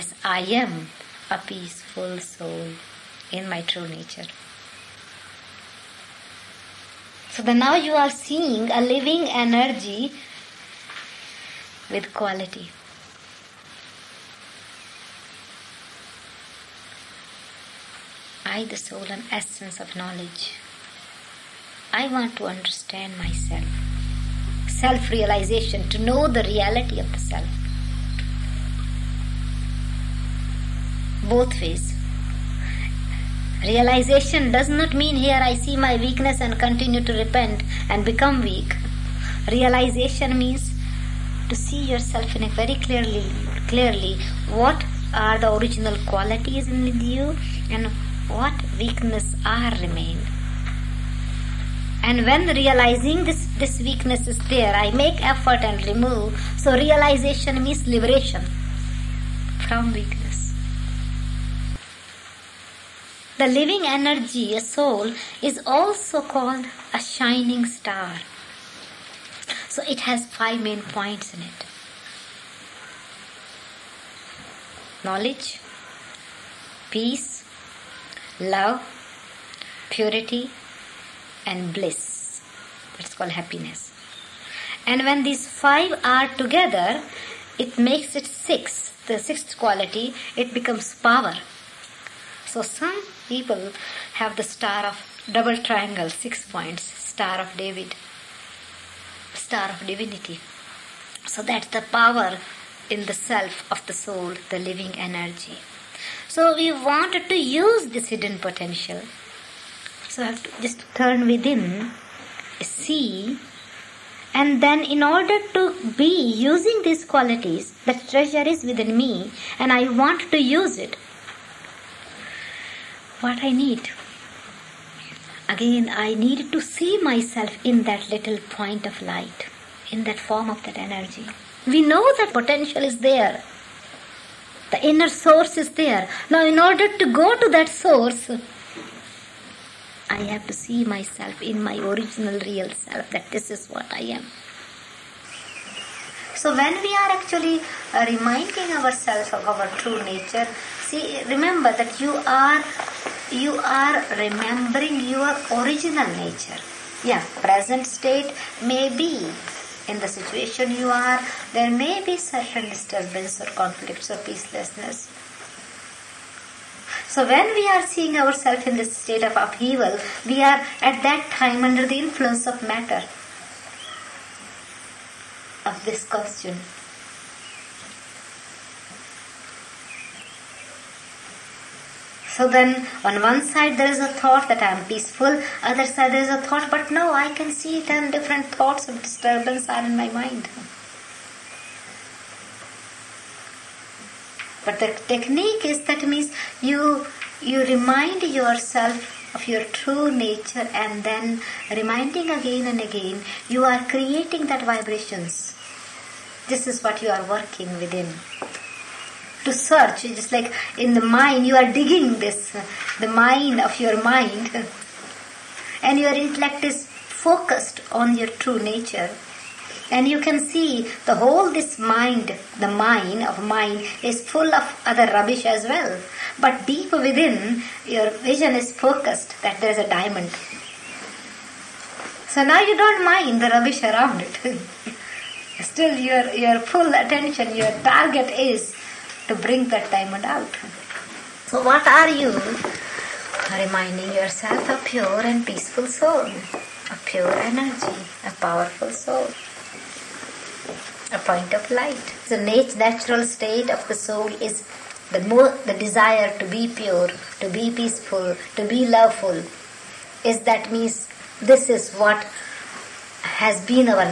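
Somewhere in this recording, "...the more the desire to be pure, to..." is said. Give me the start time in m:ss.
4:15.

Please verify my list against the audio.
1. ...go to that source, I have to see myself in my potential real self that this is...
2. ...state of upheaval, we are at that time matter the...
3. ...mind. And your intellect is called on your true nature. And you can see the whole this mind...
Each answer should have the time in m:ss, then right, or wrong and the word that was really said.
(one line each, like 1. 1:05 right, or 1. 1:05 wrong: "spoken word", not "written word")
1. 2:17 wrong: "original", not "potential"
2. 2:48 wrong: "under", not "matter"
3. 3:34 wrong: "focused", not "called".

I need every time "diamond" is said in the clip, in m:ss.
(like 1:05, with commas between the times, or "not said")
3:49, 3:59.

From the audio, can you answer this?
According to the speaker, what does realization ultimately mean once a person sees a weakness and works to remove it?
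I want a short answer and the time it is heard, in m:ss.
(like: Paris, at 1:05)
Liberation from weakness, at 0:57.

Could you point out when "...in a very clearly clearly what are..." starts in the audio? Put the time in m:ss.
0:42.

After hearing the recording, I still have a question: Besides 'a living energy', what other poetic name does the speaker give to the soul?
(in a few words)
A shining star.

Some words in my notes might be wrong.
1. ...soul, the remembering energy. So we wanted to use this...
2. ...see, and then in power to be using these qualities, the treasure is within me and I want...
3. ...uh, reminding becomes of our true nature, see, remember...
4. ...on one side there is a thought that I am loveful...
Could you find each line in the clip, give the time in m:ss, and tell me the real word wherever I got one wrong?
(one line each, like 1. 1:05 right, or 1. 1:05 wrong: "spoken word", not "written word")
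1. 1:43 wrong: "living", not "remembering"
2. 1:52 wrong: "order", not "power"
3. 2:27 wrong: "ourselves", not "becomes"
4. 3:03 wrong: "peaceful", not "loveful".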